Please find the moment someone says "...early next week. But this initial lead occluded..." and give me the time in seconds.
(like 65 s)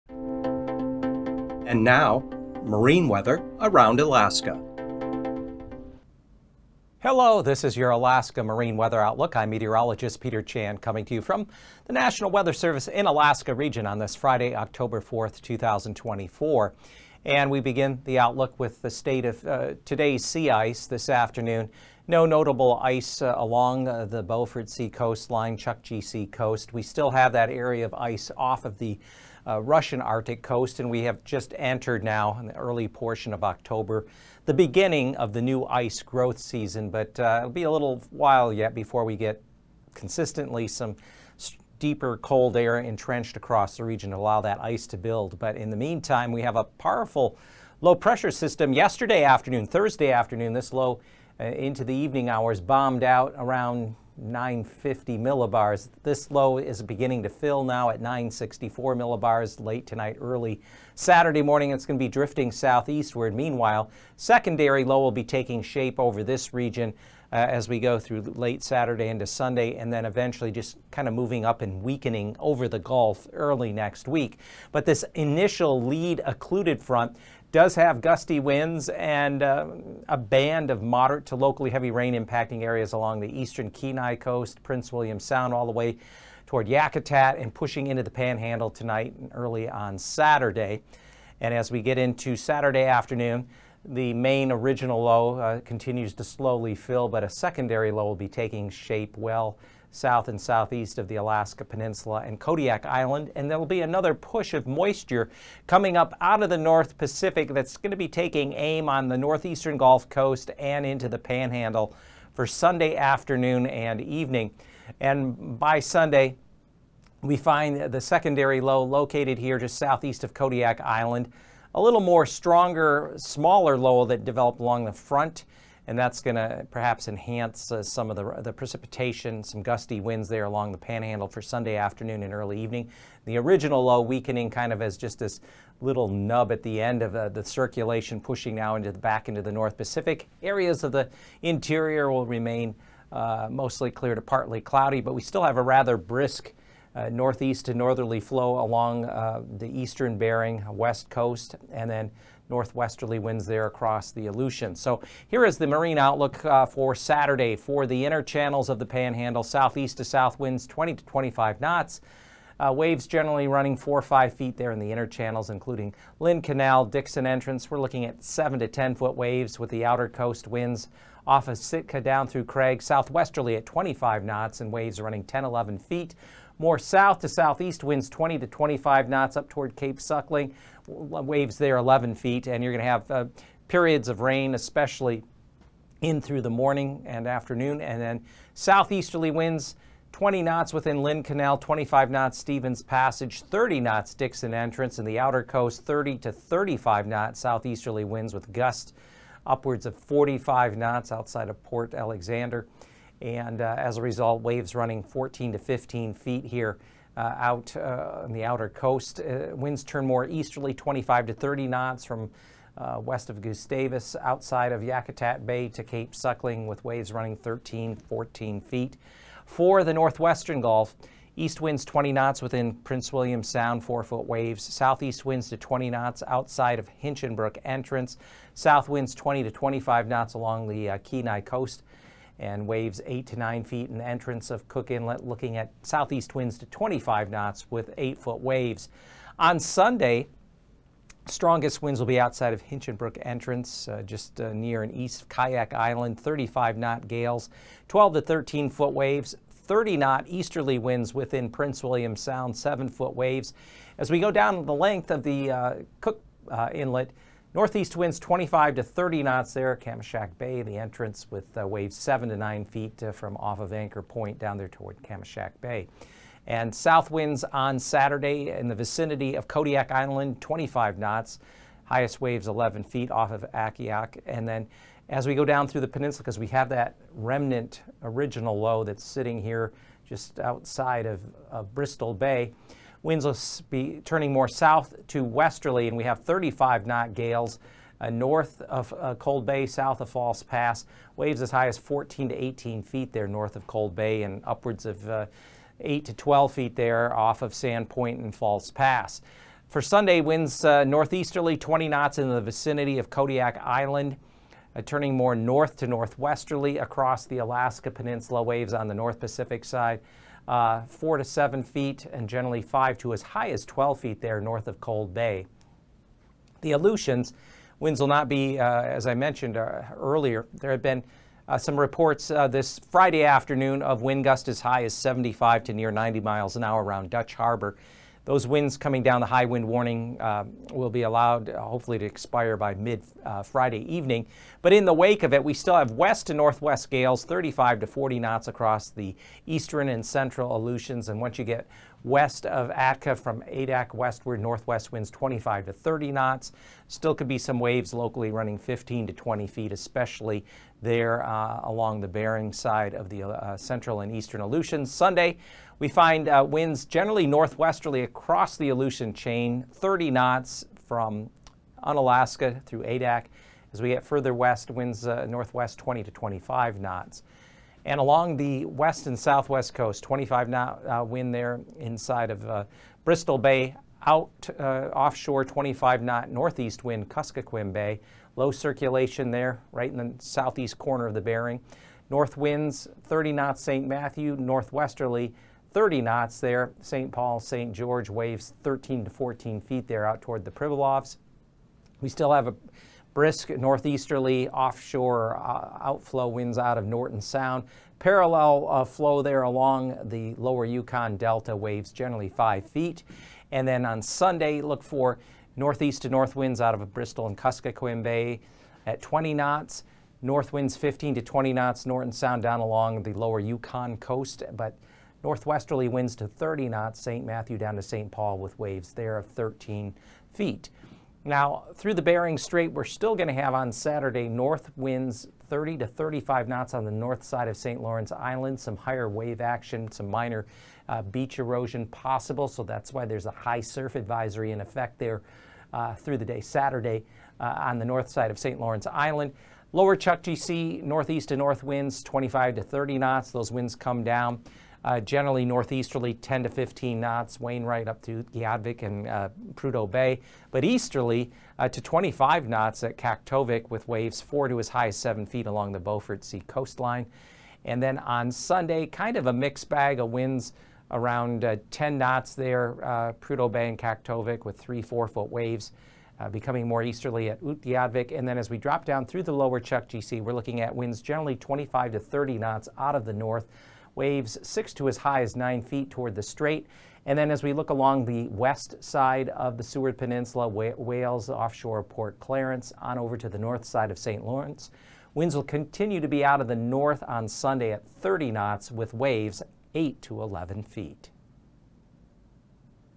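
73 s.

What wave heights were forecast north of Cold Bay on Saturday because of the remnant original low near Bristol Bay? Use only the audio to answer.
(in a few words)
14 to 18 feet.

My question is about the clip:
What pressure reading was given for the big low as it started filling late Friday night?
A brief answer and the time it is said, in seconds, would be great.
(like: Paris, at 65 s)
964 millibars, at 58 s.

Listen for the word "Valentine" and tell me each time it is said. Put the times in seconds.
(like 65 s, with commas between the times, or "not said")
not said.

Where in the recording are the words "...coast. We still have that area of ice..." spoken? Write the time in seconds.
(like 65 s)
26 s.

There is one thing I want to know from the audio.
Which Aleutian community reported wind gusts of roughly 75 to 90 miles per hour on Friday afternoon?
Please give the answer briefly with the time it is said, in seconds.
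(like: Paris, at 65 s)
Dutch Harbor, at 327 s.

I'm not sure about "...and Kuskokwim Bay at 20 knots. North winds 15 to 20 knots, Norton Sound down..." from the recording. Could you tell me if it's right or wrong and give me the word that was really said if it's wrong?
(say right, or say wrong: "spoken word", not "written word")
right.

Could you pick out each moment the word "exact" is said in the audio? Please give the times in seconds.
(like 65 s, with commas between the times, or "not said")
not said.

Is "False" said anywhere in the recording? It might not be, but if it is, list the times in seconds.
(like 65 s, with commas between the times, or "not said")
290 s, 298 s.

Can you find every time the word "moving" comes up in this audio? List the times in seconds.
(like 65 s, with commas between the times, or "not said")
71 s.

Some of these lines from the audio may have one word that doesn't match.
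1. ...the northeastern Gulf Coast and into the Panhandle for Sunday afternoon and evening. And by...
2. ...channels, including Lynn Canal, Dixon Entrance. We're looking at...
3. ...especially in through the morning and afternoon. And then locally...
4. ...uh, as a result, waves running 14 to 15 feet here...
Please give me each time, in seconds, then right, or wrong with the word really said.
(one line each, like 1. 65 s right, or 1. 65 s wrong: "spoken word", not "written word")
1. 109 s right
2. 165 s right
3. 184 s wrong: "southeasterly", not "locally"
4. 203 s right.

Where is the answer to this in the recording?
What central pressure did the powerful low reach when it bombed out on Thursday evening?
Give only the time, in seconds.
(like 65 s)
54 s.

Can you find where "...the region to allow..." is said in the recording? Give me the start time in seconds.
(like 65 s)
43 s.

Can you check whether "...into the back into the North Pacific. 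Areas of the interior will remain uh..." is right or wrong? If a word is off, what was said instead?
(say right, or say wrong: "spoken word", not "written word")
right.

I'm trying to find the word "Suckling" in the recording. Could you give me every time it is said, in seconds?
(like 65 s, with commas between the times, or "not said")
179 s, 216 s.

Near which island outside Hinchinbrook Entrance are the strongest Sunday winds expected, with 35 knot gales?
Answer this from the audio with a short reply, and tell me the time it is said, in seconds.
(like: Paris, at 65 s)
Kayak Island, at 245 s.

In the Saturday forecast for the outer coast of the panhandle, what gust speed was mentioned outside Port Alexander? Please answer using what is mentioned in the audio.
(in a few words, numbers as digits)
45 knots.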